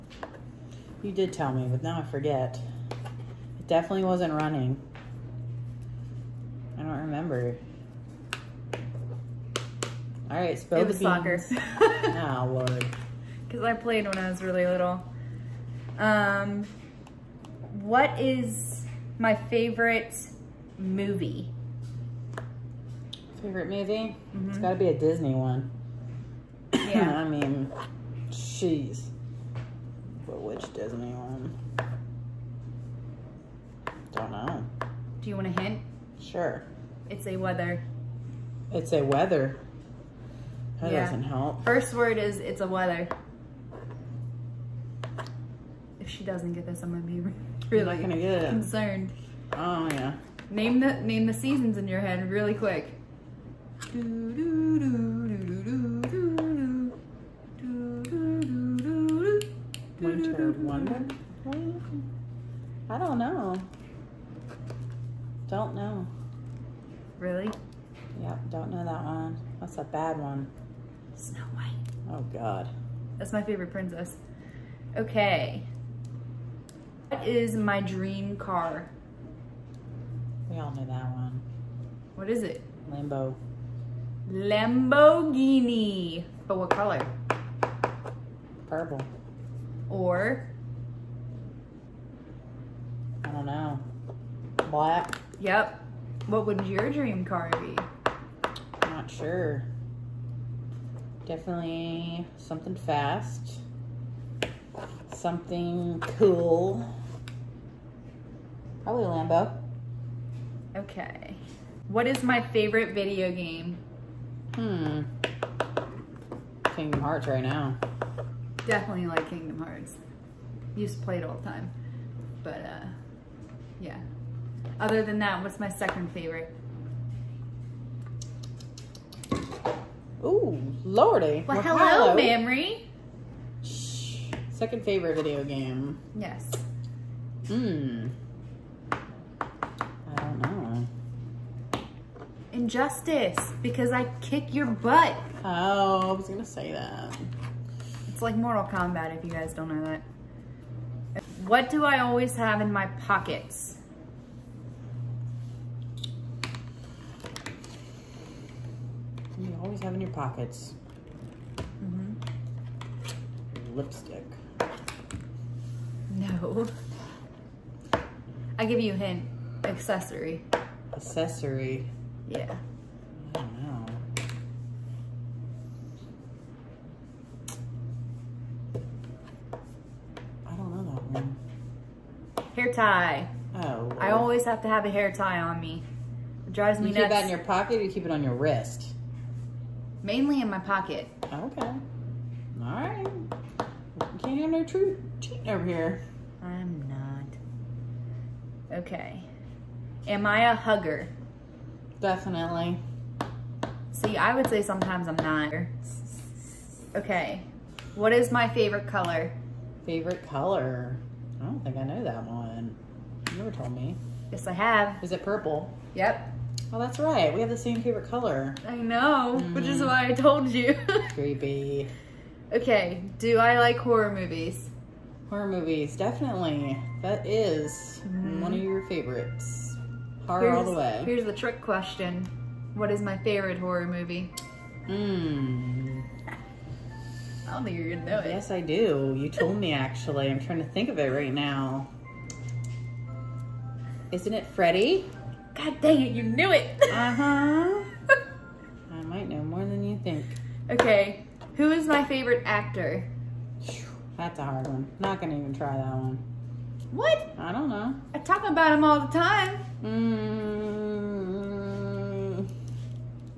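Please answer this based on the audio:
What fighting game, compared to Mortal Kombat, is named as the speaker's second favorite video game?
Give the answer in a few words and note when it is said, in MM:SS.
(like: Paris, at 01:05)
Injustice, at 02:22.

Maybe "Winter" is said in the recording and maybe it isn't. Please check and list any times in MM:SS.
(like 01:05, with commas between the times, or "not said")
00:59.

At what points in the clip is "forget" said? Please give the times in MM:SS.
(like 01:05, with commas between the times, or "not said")
00:02.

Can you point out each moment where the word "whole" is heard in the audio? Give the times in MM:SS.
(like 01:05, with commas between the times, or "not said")
not said.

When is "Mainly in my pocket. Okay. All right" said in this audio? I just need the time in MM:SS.
03:10.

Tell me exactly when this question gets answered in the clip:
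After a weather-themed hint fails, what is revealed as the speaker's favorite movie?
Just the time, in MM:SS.
01:11.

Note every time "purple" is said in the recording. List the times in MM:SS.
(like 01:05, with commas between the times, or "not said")
01:28, 03:35.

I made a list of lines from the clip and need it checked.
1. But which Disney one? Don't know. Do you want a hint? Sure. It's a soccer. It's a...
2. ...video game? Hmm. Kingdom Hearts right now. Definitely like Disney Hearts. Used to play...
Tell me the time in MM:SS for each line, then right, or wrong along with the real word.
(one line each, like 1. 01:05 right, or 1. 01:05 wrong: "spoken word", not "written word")
1. 00:30 wrong: "weather", not "soccer"
2. 01:52 wrong: "Kingdom", not "Disney".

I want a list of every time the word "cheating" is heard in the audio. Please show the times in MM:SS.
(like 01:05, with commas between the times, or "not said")
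03:15.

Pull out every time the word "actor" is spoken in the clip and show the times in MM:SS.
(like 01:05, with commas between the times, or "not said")
04:12.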